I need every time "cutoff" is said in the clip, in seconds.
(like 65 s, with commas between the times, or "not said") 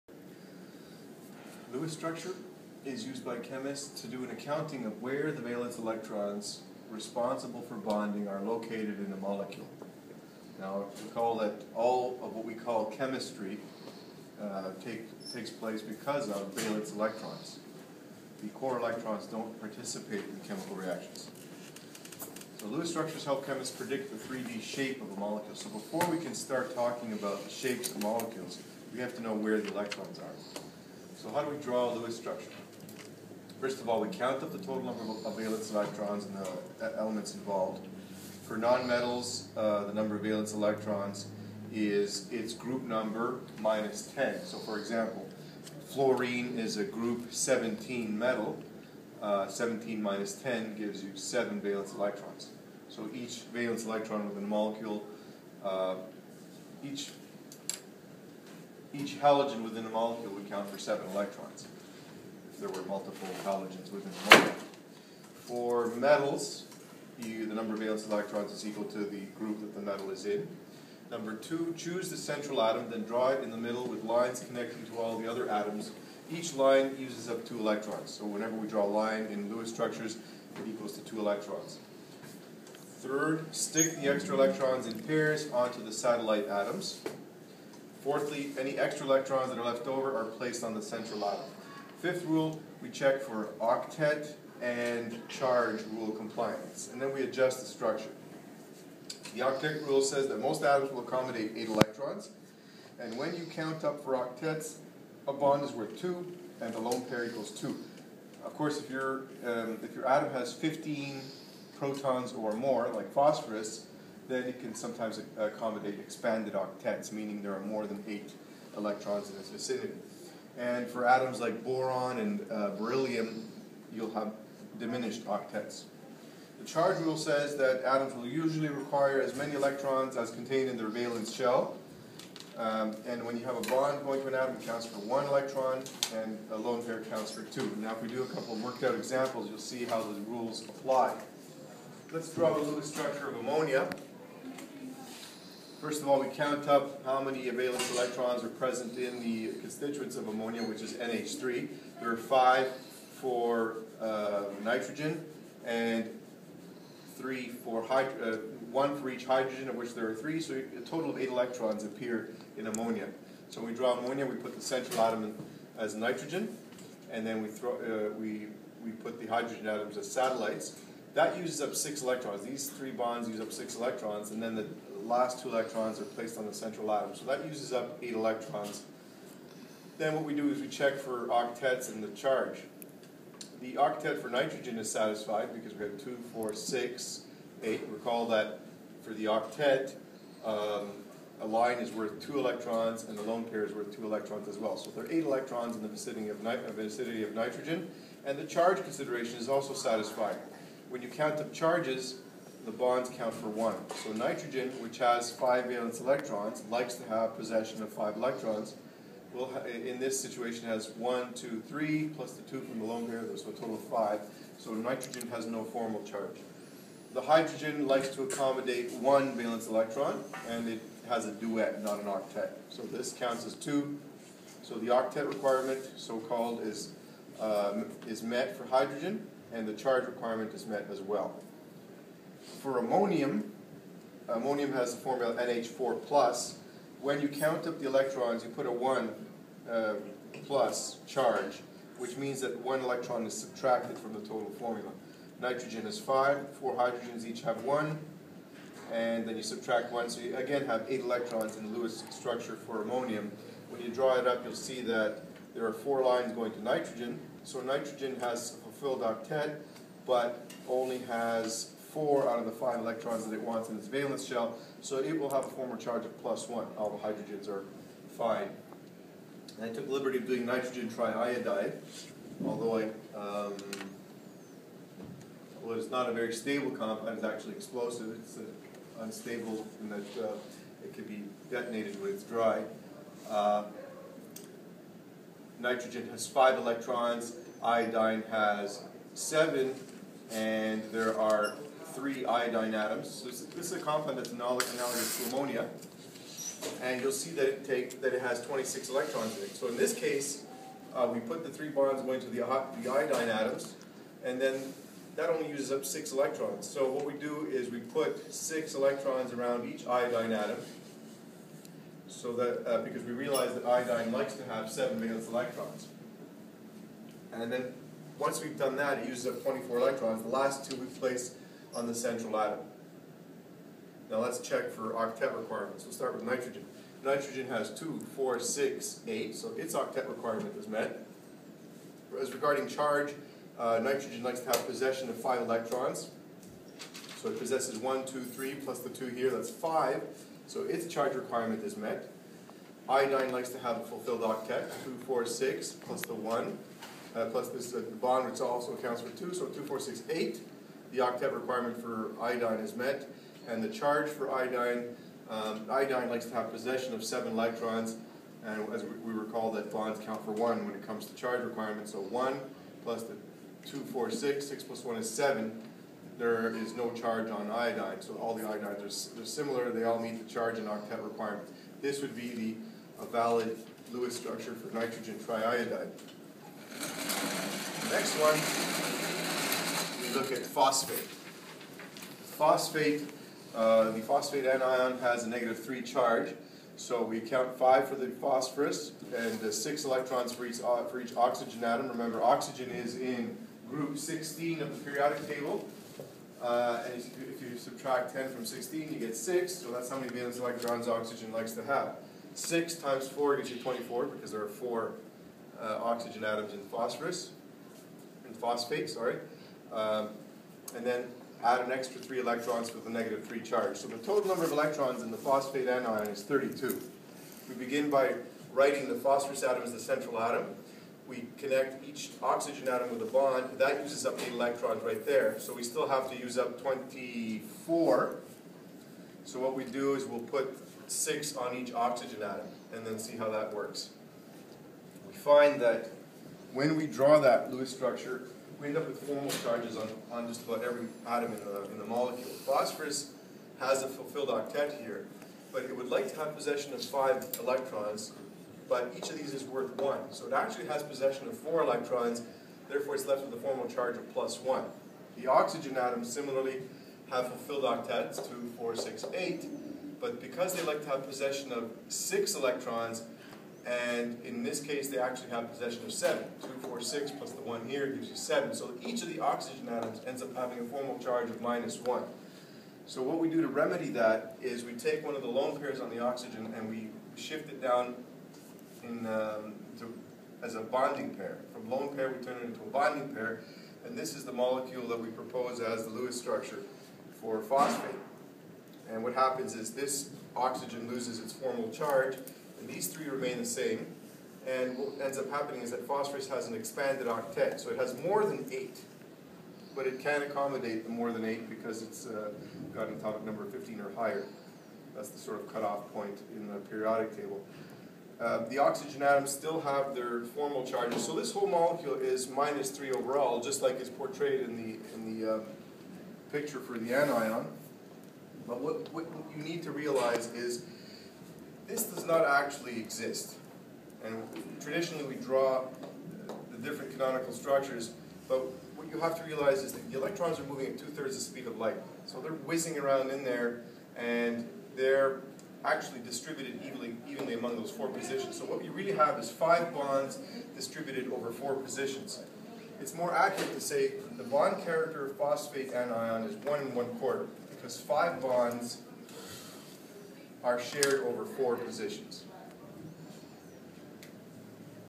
505 s.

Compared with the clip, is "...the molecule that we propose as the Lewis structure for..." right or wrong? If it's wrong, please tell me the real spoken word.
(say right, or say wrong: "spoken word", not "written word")
right.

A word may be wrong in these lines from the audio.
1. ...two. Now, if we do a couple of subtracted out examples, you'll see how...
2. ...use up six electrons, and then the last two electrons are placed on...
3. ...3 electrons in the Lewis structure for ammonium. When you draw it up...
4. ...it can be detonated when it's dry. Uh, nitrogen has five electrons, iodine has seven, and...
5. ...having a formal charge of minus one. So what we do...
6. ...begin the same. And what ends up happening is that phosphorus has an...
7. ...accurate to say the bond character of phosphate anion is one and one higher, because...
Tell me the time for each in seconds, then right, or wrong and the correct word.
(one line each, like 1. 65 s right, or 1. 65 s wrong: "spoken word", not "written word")
1. 137 s wrong: "worked", not "subtracted"
2. 173 s right
3. 250 s wrong: "8", not "3"
4. 280 s right
5. 470 s right
6. 493 s wrong: "remain", not "begin"
7. 543 s wrong: "quarter", not "higher".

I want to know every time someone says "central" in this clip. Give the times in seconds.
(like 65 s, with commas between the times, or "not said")
72 s, 90 s, 164 s, 176 s, 321 s, 419 s.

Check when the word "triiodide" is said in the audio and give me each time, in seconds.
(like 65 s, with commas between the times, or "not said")
270 s, 375 s.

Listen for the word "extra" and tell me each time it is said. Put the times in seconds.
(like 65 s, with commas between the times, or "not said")
84 s, 88 s, 411 s.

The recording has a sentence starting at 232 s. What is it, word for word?
For ammonium, ammonium has the formula NH4+.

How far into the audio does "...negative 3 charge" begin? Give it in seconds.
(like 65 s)
385 s.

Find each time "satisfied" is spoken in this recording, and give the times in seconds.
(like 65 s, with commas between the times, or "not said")
184 s, 199 s.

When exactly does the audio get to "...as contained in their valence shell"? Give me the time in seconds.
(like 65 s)
130 s.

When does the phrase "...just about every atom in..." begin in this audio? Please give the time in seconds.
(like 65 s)
440 s.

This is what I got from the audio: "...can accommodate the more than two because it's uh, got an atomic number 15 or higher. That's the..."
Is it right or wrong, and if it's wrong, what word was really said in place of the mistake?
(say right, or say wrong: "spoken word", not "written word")
wrong: "eight", not "two".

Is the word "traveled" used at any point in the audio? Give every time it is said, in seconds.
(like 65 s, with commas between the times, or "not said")
not said.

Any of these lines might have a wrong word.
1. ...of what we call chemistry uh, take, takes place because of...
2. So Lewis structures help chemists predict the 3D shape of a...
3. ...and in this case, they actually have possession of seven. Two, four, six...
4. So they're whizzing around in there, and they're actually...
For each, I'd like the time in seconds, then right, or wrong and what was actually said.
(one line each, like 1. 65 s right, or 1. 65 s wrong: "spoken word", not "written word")
1. 12 s right
2. 22 s right
3. 463 s right
4. 532 s right.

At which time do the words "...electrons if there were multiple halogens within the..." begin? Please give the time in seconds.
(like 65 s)
61 s.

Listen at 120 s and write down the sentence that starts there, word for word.
And for atoms like boron and uh, beryllium, you'll have diminished octets.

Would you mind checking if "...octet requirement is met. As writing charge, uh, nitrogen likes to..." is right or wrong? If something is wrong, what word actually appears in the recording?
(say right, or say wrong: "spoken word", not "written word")
wrong: "regarding", not "writing".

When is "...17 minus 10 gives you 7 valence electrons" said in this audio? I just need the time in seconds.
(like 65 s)
49 s.